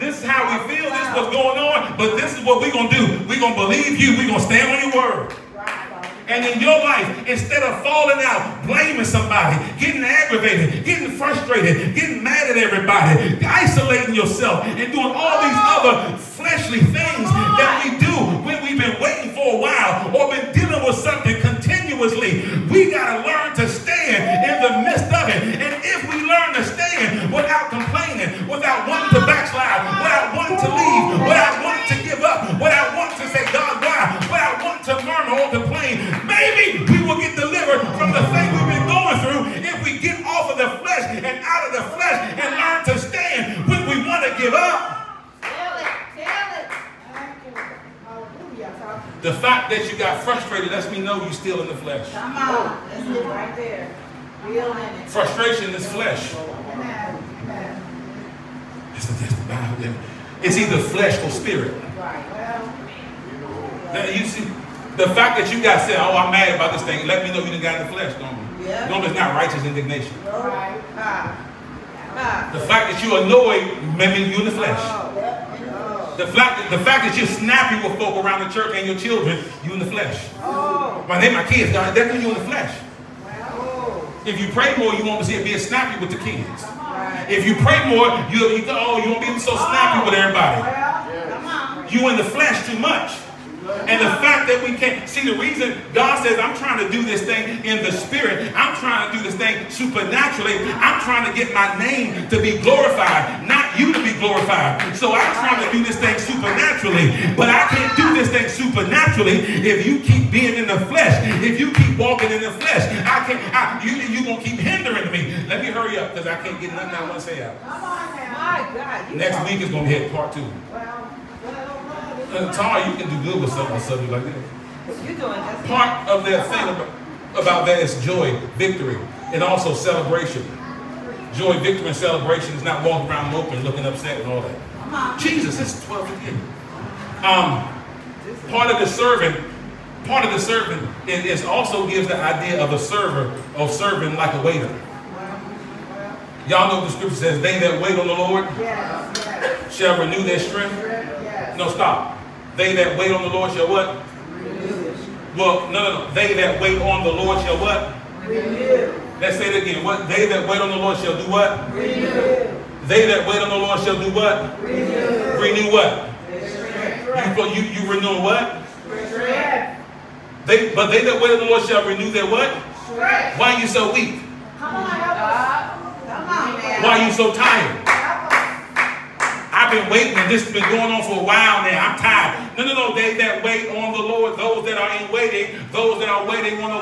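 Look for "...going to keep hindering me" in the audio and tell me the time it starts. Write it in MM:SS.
01:54.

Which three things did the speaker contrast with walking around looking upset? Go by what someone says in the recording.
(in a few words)
Joy, victory, and celebration.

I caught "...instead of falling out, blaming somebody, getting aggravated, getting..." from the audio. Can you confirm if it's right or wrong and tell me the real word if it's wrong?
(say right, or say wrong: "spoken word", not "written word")
right.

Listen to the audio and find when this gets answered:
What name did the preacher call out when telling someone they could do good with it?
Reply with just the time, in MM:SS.
02:02.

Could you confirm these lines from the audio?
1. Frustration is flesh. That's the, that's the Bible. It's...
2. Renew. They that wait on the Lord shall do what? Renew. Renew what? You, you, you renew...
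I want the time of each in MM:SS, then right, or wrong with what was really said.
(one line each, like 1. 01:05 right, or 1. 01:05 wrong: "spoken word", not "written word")
1. 00:55 right
2. 02:41 right.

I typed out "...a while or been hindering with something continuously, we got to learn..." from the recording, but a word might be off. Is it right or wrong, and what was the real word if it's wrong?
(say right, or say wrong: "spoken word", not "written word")
wrong: "dealing", not "hindering".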